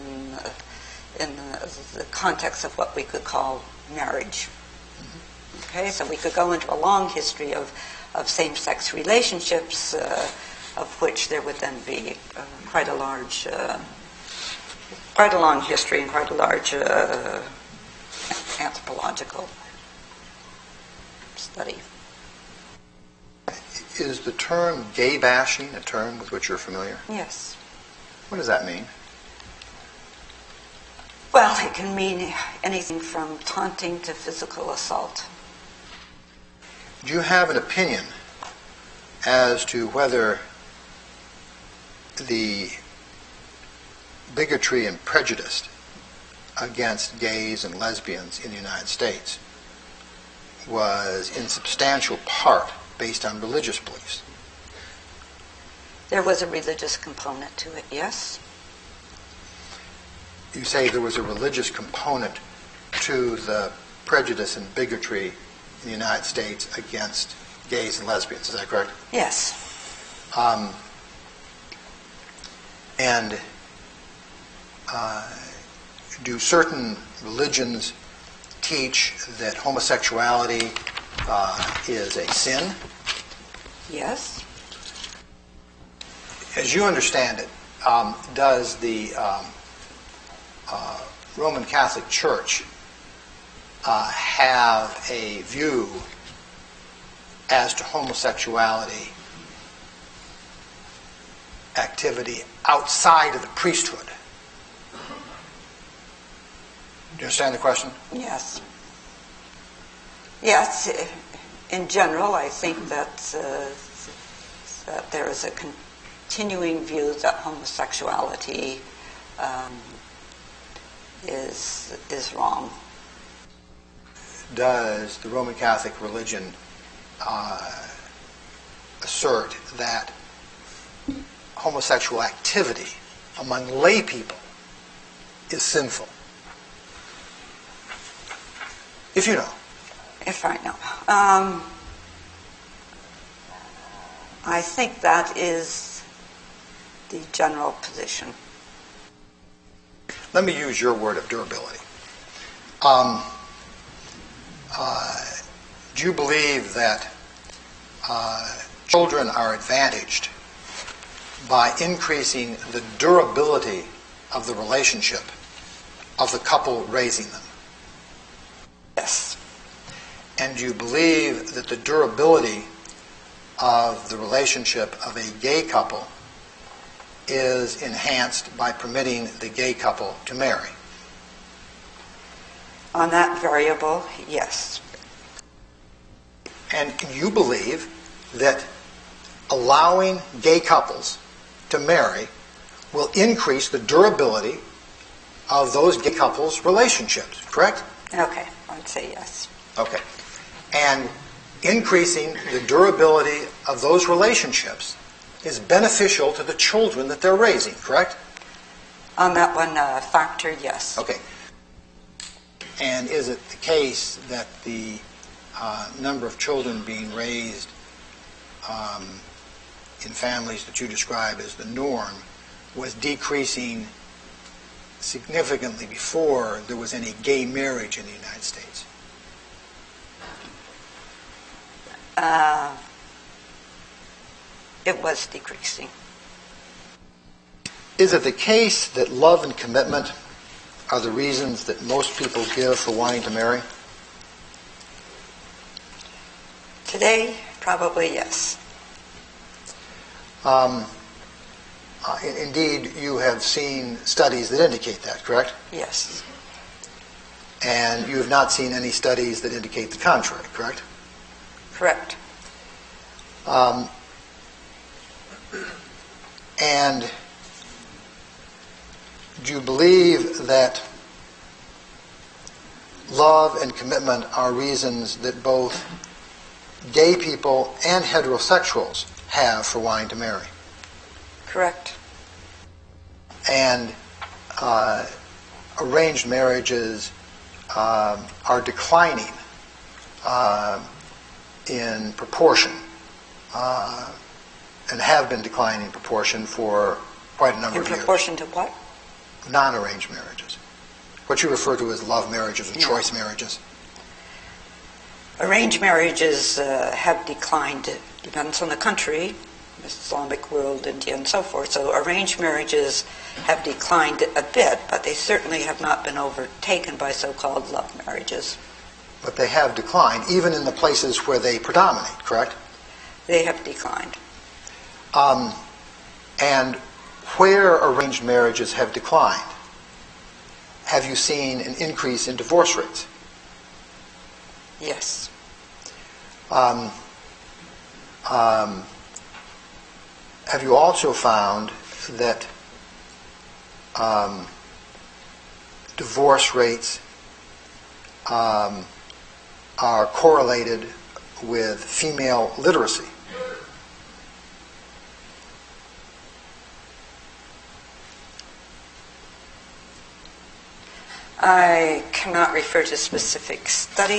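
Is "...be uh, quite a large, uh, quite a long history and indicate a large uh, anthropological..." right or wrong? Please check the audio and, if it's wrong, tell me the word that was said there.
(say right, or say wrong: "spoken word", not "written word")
wrong: "quite", not "indicate".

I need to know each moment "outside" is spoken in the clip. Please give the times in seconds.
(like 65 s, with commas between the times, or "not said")
102 s.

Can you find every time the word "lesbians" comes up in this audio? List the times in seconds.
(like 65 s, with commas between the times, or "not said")
47 s, 68 s.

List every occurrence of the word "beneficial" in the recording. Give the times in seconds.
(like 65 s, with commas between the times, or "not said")
205 s.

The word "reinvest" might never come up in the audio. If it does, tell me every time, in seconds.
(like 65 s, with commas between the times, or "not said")
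not said.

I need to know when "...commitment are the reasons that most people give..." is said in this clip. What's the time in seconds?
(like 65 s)
239 s.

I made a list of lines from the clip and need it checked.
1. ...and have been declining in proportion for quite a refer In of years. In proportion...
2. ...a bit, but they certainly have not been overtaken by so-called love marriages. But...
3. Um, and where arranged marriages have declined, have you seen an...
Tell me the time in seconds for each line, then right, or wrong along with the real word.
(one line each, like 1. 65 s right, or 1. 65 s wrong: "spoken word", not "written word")
1. 294 s wrong: "number", not "refer"
2. 314 s right
3. 325 s right.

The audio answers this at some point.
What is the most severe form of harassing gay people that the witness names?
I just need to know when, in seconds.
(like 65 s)
34 s.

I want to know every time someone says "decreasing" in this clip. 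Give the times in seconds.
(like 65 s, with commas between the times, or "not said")
222 s, 235 s.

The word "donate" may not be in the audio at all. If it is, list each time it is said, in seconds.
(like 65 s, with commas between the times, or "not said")
not said.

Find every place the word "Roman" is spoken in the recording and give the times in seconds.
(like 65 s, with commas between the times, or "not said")
91 s, 125 s.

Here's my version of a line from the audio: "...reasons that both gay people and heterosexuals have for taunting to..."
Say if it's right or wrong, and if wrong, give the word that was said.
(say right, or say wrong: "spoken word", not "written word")
wrong: "wanting", not "taunting".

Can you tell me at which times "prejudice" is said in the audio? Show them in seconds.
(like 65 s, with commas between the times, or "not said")
45 s, 64 s.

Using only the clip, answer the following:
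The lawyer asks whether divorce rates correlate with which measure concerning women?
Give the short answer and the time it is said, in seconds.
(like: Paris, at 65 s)
female literacy, at 351 s.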